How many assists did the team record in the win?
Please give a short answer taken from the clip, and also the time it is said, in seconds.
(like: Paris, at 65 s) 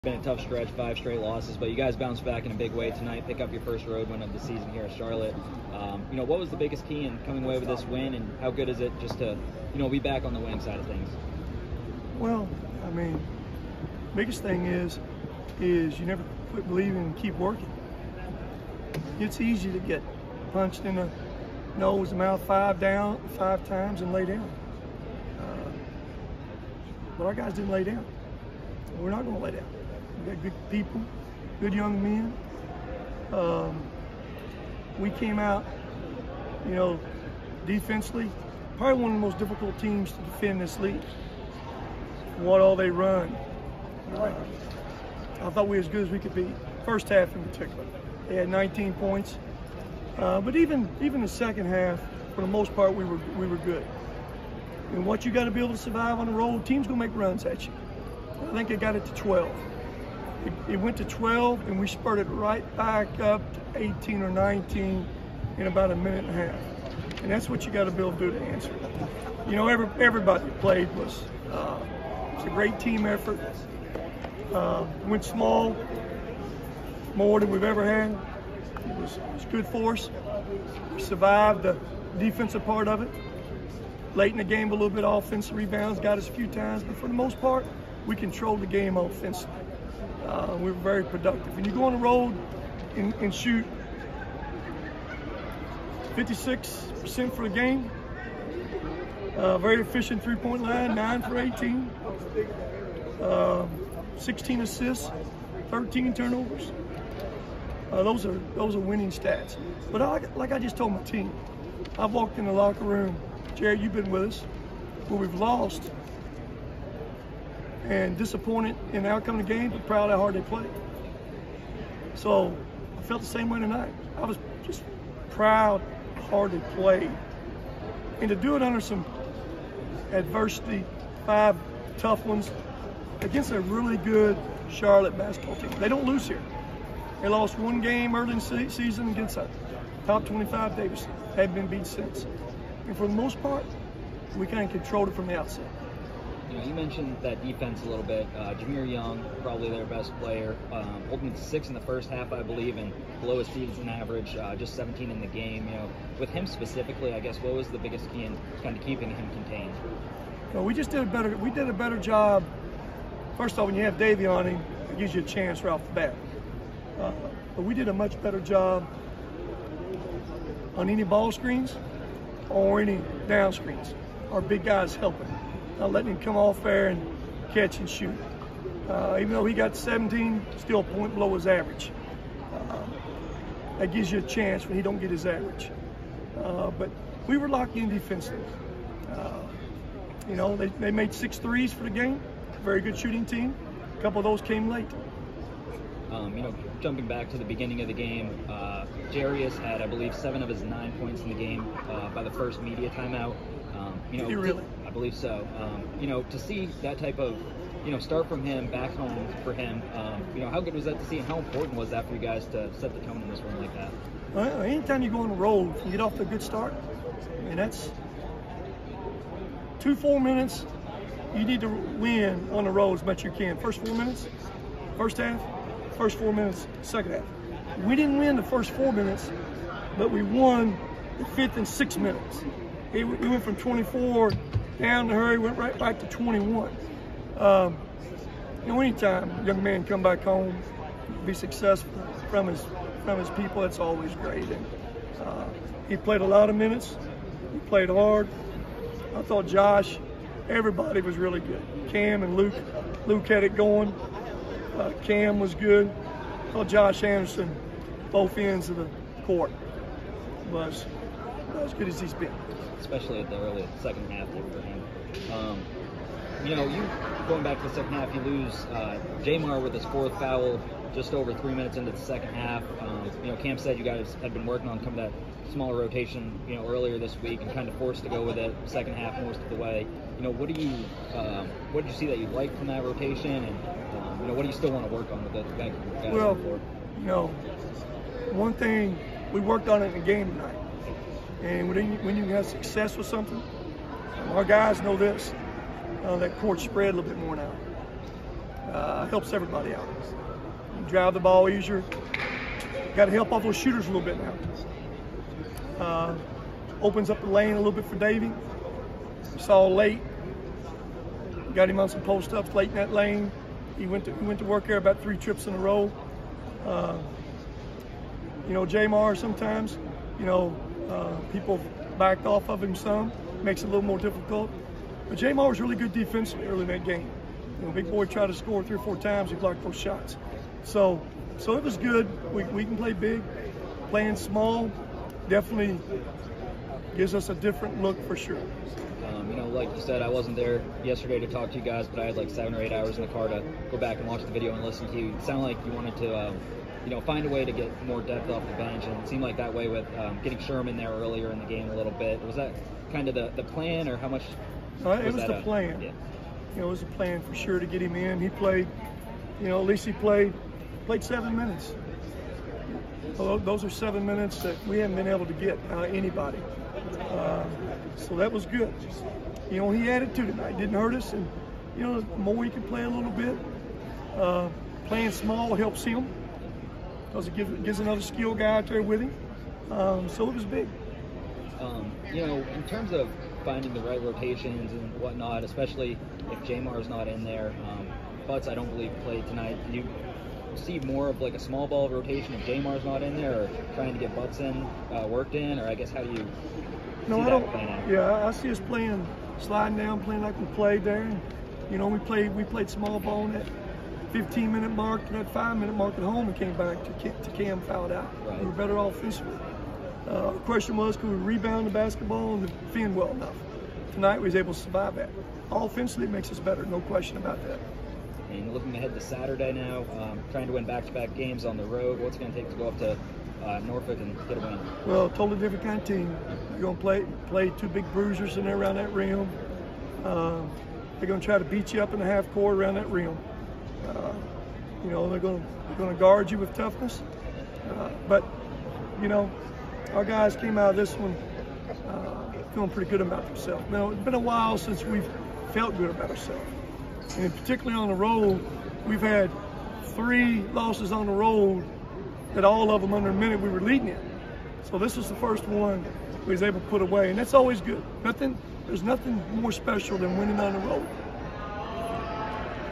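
16, at 104 s.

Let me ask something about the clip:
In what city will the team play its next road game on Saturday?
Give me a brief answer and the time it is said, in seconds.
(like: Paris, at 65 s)
Norfolk, at 423 s.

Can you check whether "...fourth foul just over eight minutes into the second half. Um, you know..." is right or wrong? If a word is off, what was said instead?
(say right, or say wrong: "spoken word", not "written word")
wrong: "three", not "eight".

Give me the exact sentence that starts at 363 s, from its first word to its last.
Although those are seven minutes that we haven't been able to get anybody.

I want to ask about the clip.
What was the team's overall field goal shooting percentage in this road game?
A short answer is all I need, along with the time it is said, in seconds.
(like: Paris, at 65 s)
56%, at 96 s.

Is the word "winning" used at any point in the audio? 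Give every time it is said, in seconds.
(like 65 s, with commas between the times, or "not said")
10 s, 108 s, 460 s.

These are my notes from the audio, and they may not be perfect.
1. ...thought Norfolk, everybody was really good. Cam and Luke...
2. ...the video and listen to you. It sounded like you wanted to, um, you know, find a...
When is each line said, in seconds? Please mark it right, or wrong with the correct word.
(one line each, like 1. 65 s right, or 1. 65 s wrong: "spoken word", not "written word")
1. 249 s wrong: "Josh", not "Norfolk"
2. 344 s right.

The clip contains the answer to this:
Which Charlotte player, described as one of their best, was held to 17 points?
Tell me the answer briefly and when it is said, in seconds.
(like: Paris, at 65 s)
Jahmir Young, at 148 s.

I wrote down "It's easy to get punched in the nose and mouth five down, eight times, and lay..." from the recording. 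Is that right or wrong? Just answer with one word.
wrong.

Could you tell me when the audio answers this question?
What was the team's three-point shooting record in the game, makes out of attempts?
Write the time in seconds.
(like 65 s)
100 s.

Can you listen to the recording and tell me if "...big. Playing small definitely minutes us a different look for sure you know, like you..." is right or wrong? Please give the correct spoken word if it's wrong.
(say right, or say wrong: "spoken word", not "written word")
wrong: "gives", not "minutes".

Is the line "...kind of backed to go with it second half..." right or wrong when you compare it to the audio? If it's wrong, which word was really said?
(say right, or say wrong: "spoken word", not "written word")
wrong: "forced", not "backed".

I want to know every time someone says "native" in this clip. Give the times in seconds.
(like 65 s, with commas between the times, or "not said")
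not said.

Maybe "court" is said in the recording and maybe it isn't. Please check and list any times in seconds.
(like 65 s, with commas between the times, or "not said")
259 s, 296 s, 432 s.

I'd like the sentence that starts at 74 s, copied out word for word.
Uh, went small, more than we've ever had.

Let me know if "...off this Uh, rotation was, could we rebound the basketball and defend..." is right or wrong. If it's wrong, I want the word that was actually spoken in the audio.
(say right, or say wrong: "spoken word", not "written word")
wrong: "question", not "rotation".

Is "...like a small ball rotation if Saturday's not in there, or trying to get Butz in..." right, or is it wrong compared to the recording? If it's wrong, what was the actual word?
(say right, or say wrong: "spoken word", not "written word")
wrong: "Jamar", not "Saturday".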